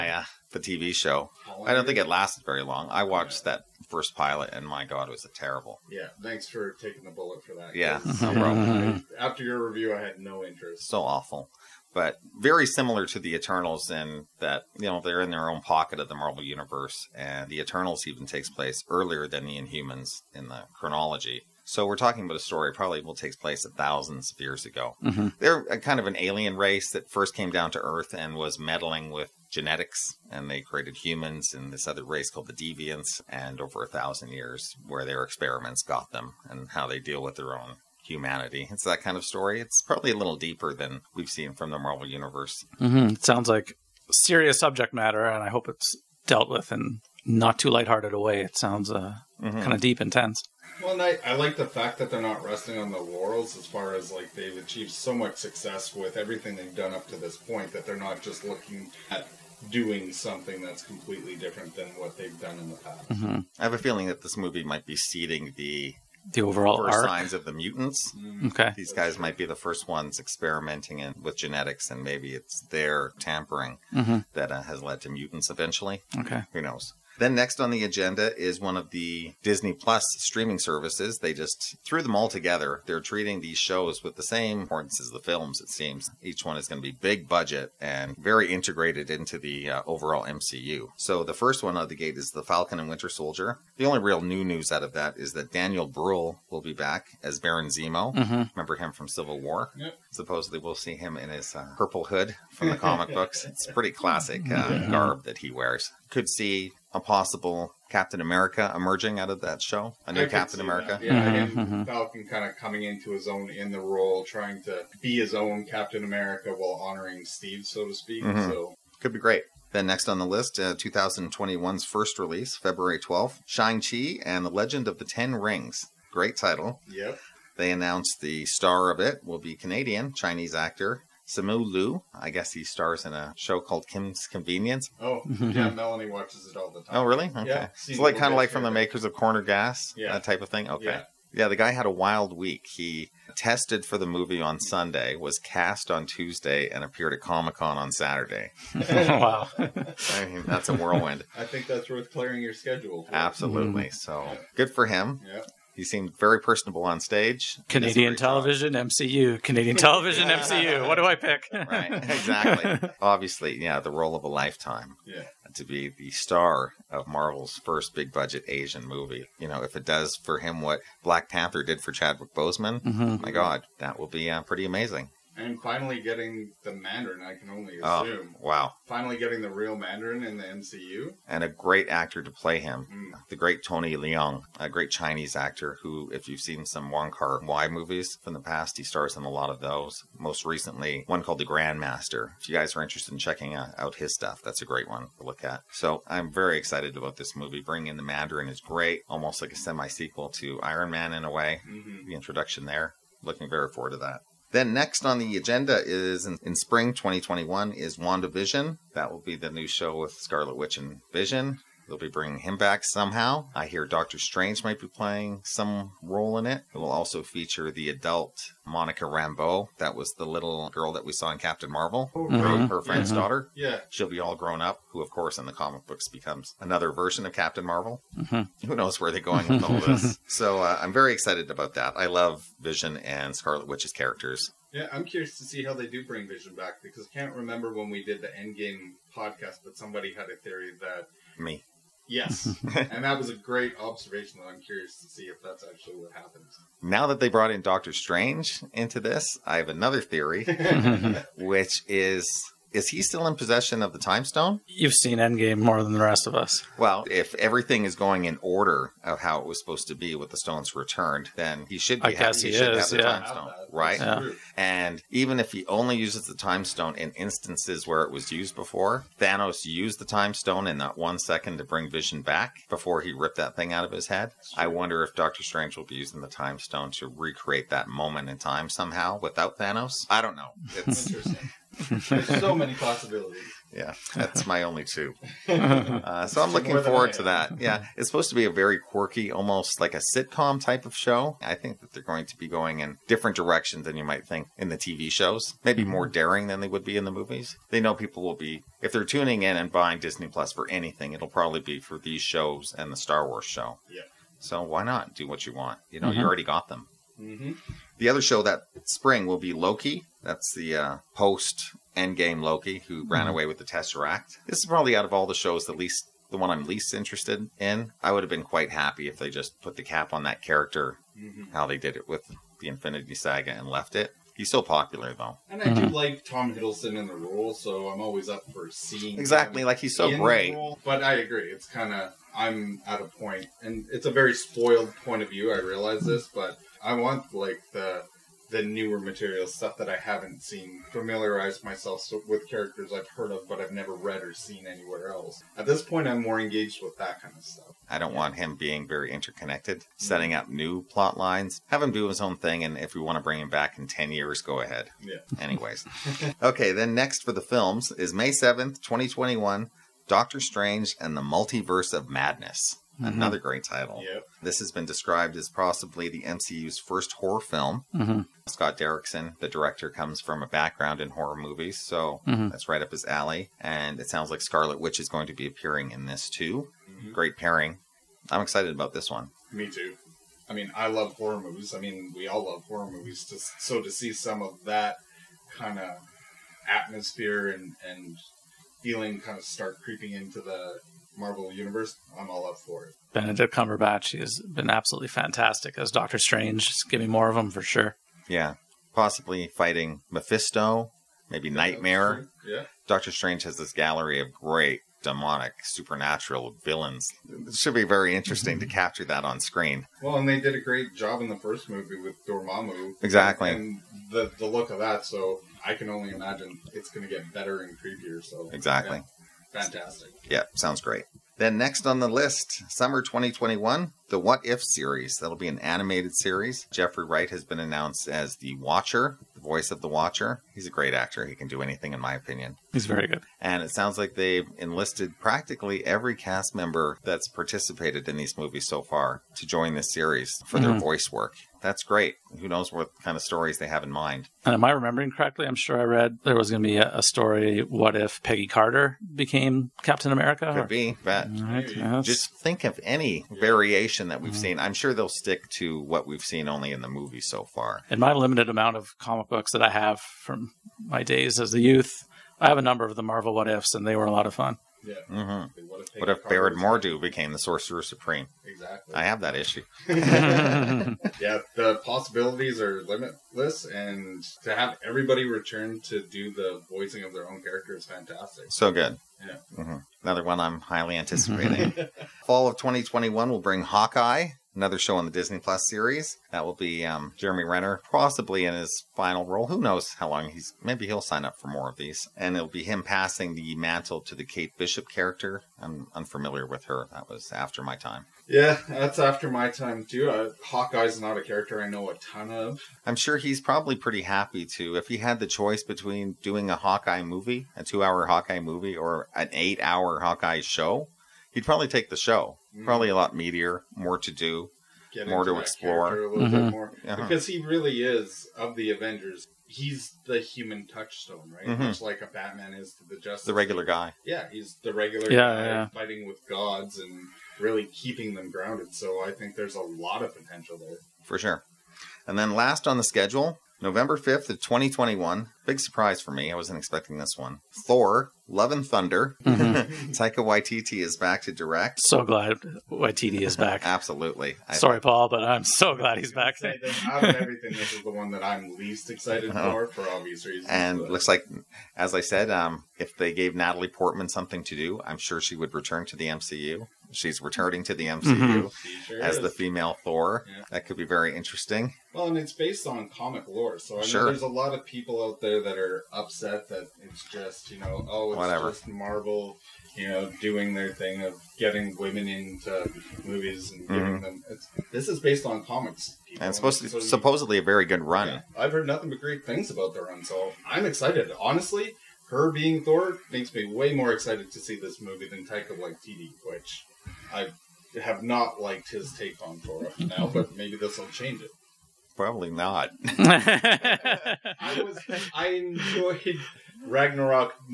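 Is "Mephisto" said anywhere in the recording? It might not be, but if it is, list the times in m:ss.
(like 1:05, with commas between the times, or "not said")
6:40.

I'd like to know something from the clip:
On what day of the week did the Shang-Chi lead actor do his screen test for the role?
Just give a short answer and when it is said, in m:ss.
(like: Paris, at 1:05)
Sunday, at 2:24.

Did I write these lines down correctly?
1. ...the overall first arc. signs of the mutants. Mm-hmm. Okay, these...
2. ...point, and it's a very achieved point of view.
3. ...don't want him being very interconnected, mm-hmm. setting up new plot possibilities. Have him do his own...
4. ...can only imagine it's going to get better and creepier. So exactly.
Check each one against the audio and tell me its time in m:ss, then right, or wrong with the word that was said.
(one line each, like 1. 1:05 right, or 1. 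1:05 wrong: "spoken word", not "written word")
1. 1:06 right
2. 5:33 wrong: "spoiled", not "achieved"
3. 5:47 wrong: "lines", not "possibilities"
4. 6:55 right.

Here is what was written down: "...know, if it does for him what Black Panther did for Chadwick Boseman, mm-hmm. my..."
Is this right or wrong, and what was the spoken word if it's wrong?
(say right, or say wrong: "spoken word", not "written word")
right.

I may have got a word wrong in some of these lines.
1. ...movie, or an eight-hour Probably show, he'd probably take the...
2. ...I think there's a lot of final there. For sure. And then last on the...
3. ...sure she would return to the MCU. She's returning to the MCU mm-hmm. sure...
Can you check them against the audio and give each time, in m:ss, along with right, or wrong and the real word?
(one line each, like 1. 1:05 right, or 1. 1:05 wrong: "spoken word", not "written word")
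1. 8:28 wrong: "Hawkeye", not "Probably"
2. 8:49 wrong: "potential", not "final"
3. 9:14 right.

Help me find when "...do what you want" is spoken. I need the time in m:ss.
5:05.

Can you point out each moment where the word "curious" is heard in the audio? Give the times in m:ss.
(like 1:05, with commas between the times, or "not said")
3:55, 4:04.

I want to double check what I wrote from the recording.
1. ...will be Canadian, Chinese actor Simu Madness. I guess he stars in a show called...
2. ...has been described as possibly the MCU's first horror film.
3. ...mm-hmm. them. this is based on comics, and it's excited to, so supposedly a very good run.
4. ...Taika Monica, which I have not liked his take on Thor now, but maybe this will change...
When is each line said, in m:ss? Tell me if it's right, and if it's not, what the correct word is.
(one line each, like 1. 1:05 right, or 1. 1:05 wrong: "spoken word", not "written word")
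1. 2:09 wrong: "Liu", not "Madness"
2. 6:04 right
3. 9:34 wrong: "supposed", not "excited"
4. 9:45 wrong: "Waititi", not "Monica".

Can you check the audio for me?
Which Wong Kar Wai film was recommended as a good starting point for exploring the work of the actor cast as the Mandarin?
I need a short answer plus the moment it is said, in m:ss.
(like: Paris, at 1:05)
The Grandmaster, at 3:11.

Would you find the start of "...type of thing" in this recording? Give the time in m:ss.
2:20.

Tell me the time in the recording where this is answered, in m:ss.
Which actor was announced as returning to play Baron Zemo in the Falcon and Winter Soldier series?
1:35.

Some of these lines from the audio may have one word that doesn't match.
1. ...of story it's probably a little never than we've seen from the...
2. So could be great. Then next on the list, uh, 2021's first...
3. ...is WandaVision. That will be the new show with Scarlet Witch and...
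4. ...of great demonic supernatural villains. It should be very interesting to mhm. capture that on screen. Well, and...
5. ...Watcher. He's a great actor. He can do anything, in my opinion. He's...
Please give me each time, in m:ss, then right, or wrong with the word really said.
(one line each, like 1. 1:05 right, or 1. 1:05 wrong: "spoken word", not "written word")
1. 0:39 wrong: "deeper", not "never"
2. 1:58 right
3. 3:27 right
4. 6:44 right
5. 7:09 right.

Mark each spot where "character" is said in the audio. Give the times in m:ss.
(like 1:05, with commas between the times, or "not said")
3:53, 5:20, 5:42, 7:57, 8:14, 8:21.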